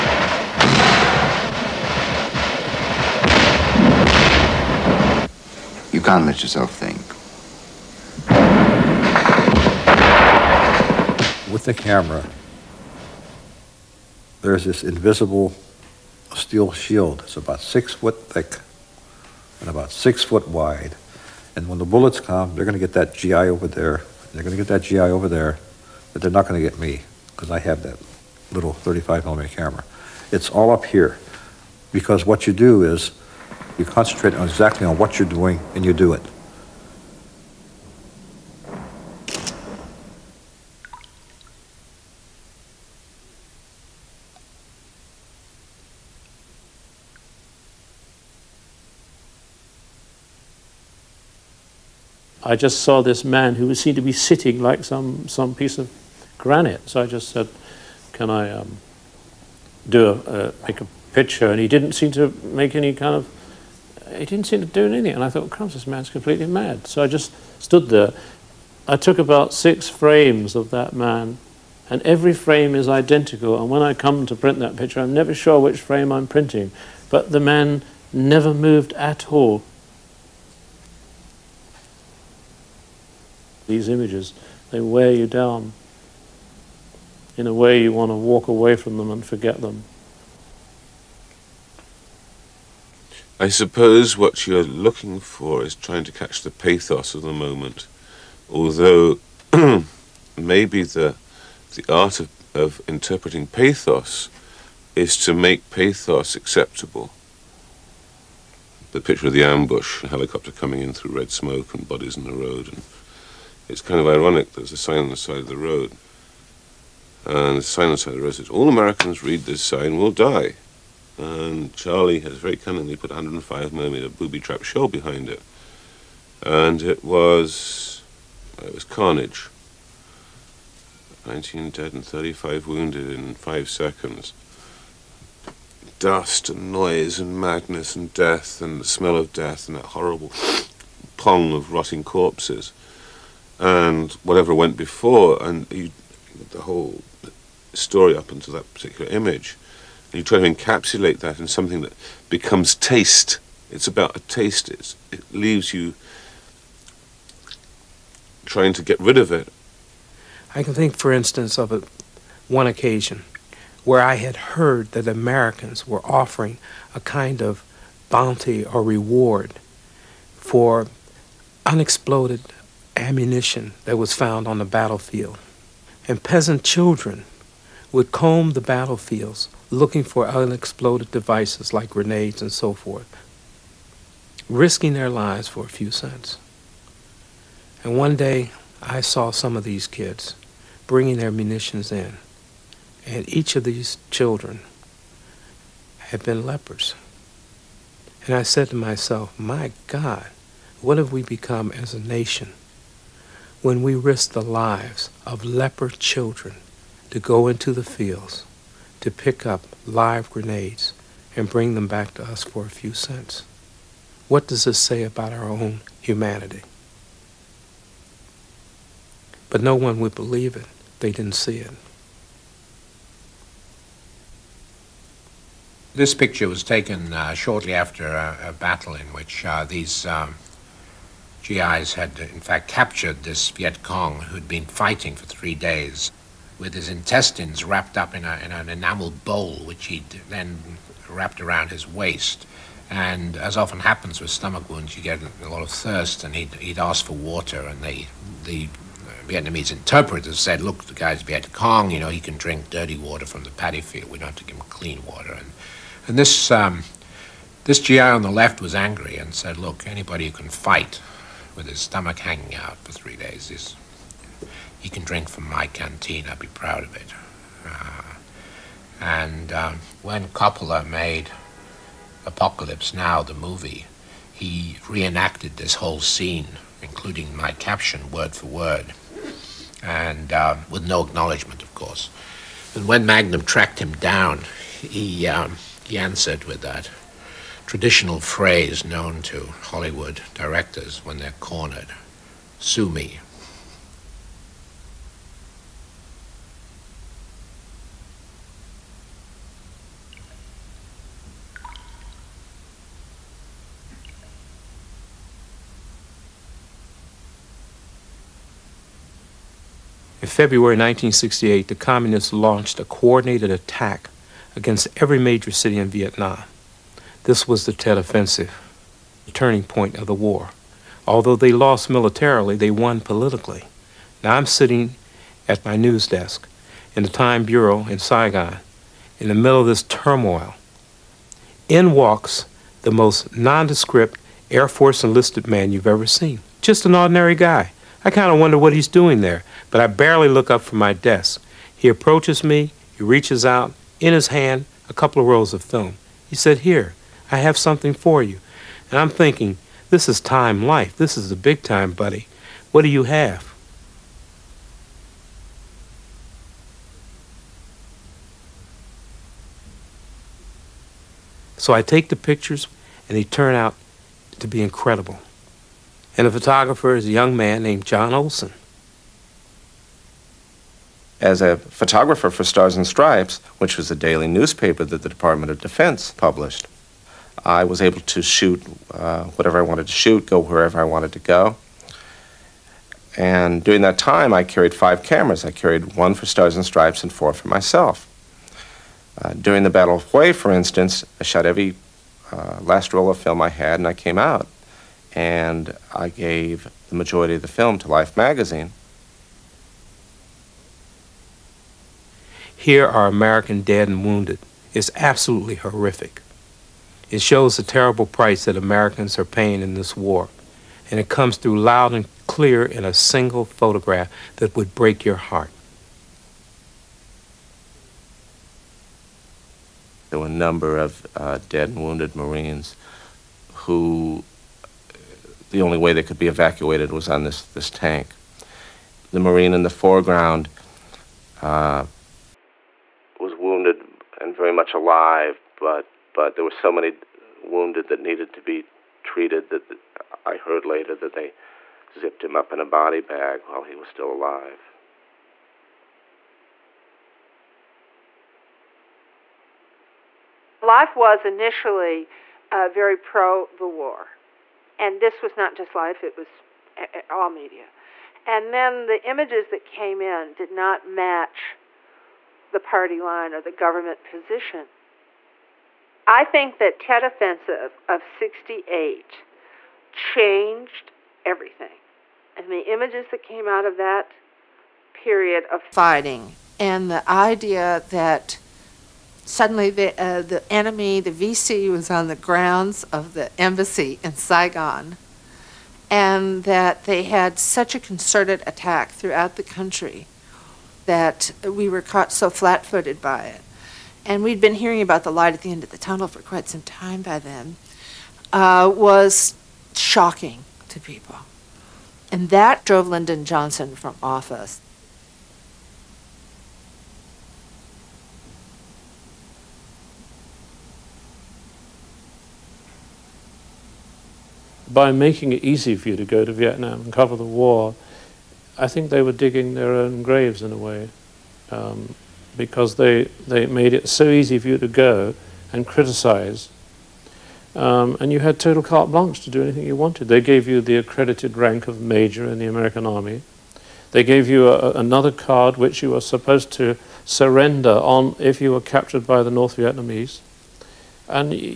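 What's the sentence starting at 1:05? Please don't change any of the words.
And I thought, crumbs, this man's completely mad.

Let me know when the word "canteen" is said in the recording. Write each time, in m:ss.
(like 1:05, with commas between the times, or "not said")
4:25.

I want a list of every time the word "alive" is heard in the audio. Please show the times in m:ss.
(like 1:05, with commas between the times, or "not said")
7:14, 7:24.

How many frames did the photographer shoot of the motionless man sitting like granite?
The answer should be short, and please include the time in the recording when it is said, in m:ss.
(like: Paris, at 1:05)
6, at 1:09.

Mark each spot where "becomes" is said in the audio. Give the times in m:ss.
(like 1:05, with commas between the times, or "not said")
2:32, 3:21.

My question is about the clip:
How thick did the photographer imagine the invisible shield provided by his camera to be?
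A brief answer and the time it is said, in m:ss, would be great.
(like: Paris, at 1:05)
6 foot, at 0:17.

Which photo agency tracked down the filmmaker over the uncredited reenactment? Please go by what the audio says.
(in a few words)
Magnum.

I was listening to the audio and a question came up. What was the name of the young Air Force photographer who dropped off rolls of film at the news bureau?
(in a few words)
John Olson.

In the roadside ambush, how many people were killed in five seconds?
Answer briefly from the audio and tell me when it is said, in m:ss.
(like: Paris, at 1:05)
19, at 2:11.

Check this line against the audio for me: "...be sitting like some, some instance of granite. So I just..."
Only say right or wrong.
wrong.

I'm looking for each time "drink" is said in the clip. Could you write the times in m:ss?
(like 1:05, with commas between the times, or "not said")
4:12, 4:25.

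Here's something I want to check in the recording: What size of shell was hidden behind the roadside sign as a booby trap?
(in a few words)
105 millimeter.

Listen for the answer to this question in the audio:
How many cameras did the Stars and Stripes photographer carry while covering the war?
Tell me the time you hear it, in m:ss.
6:24.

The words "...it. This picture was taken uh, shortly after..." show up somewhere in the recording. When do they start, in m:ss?
3:41.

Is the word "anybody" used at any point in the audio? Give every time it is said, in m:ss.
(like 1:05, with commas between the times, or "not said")
4:19.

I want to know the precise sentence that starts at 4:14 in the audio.
We don't have to give him clean water.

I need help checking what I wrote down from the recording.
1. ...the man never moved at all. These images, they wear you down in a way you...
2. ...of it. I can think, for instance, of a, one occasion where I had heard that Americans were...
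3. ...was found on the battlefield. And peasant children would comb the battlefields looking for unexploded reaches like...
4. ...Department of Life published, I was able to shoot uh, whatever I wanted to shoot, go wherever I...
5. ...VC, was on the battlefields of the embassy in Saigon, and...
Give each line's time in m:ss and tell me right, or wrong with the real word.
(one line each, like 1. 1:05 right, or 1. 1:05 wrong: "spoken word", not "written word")
1. 1:17 right
2. 2:39 right
3. 2:53 wrong: "devices", not "reaches"
4. 6:15 wrong: "Defense", not "Life"
5. 8:01 wrong: "grounds", not "battlefields".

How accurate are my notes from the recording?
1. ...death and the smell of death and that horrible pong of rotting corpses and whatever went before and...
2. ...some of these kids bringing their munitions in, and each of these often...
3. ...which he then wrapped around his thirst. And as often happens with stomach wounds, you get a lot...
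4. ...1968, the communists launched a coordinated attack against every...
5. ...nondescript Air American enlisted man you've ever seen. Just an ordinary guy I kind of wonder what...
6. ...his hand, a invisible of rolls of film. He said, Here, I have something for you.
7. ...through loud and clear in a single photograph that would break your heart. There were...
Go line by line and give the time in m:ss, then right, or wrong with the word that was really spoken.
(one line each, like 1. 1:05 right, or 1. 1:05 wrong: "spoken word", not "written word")
1. 2:18 right
2. 3:09 wrong: "children", not "often"
3. 3:59 wrong: "waist", not "thirst"
4. 5:10 right
5. 5:33 wrong: "Force", not "American"
6. 5:44 wrong: "couple", not "invisible"
7. 6:51 right.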